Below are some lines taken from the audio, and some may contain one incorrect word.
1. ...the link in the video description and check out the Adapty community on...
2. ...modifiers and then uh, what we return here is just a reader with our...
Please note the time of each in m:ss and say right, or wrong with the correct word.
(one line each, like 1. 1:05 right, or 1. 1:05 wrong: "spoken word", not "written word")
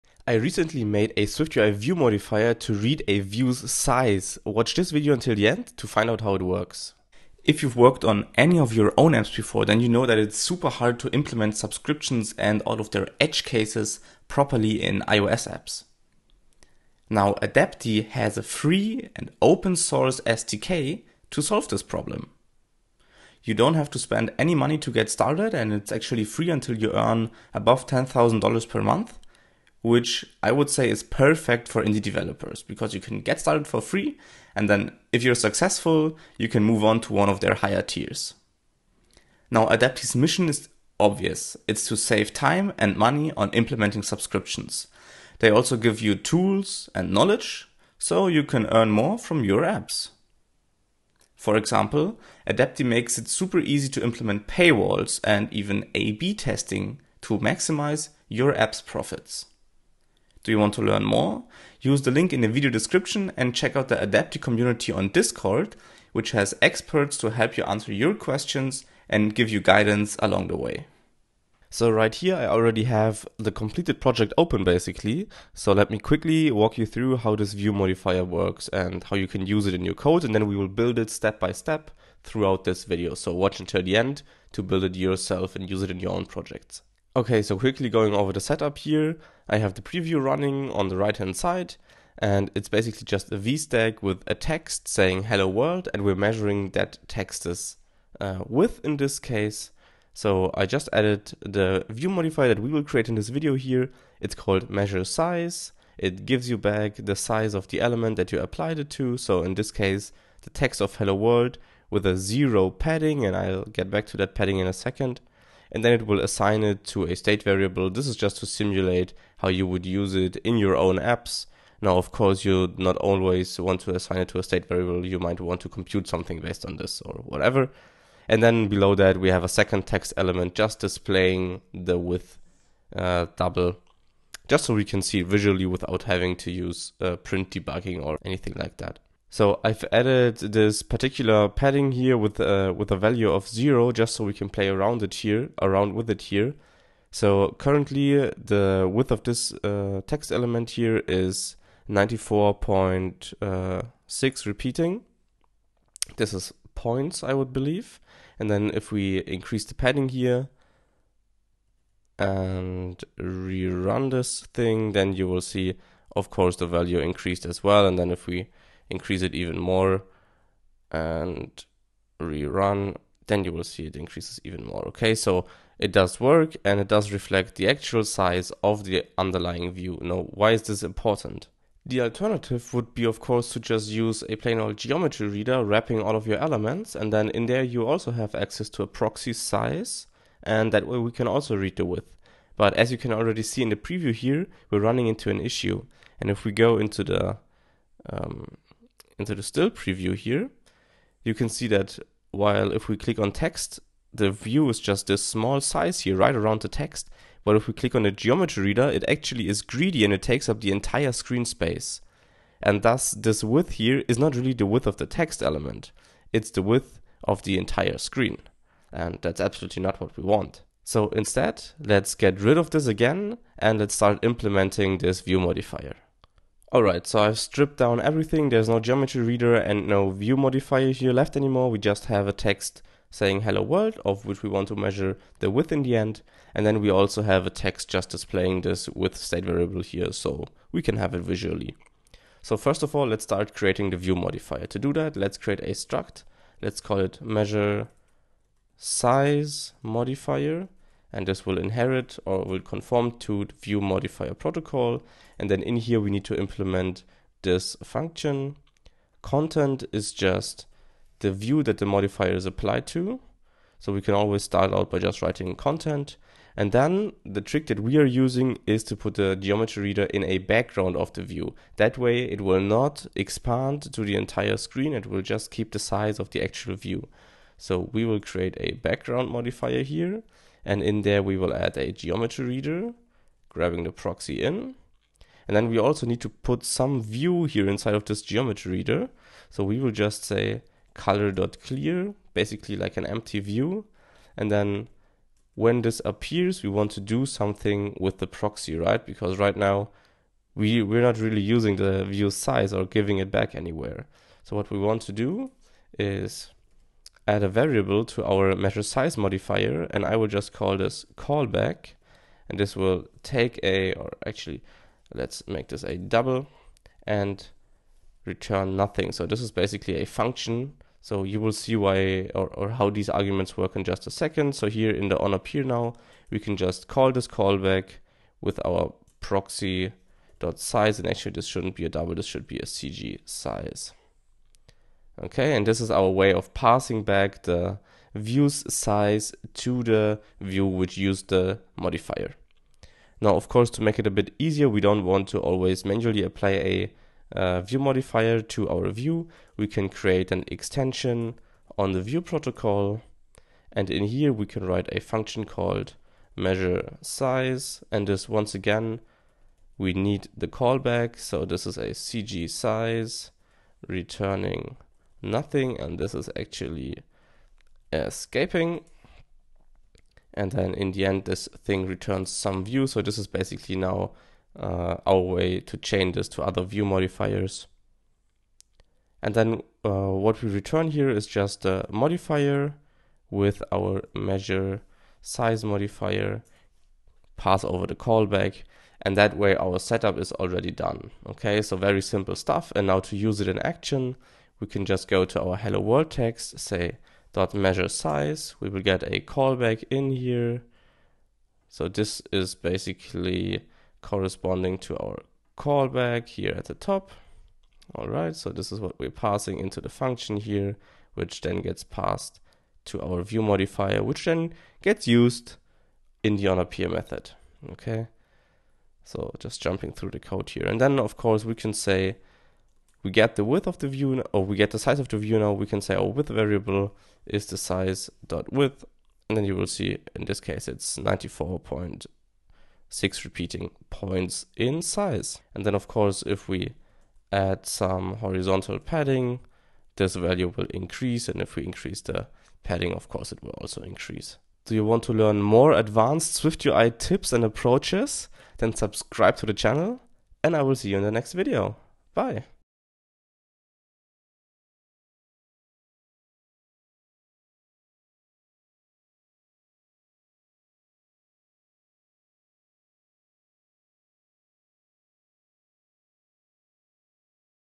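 1. 1:02 right
2. 6:16 wrong: "modifier", not "reader".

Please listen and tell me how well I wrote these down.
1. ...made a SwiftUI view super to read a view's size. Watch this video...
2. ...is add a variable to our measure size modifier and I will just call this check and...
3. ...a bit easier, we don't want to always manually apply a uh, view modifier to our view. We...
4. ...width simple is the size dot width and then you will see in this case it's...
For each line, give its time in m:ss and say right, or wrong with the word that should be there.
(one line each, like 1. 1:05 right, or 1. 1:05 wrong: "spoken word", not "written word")
1. 0:00 wrong: "modifier", not "super"
2. 5:05 wrong: "callback", not "check"
3. 5:44 right
4. 7:06 wrong: "variable", not "simple".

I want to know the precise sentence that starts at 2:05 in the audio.
You might want to compute something based on this or whatever.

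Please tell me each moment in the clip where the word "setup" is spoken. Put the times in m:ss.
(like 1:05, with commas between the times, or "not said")
1:28, 6:29.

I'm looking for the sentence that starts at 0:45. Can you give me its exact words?
They also give you tools and knowledge so you can earn more from your apps.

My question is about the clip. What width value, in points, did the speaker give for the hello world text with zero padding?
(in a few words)
94.6 repeating.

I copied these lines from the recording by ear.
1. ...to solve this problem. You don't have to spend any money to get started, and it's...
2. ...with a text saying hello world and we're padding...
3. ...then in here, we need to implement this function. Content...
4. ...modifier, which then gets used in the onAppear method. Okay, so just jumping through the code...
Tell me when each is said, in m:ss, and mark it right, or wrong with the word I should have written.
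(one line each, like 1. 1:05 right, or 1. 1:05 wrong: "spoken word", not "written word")
1. 0:21 right
2. 1:34 wrong: "measuring", not "padding"
3. 4:15 right
4. 6:53 right.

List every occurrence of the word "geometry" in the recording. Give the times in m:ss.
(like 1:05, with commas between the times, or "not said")
3:04, 3:28, 3:48, 4:29, 4:41, 4:48.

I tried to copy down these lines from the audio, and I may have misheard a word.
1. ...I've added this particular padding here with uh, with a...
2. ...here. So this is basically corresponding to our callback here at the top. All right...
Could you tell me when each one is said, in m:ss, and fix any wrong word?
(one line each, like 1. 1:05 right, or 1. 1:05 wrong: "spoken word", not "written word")
1. 2:19 right
2. 6:40 right.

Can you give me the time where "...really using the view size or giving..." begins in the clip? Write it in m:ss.
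5:01.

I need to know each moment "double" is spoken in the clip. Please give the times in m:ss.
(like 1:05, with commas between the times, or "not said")
2:13, 5:15, 5:31.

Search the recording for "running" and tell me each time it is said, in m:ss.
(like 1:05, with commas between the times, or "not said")
1:30, 3:14.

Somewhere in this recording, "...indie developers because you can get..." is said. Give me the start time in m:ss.
0:31.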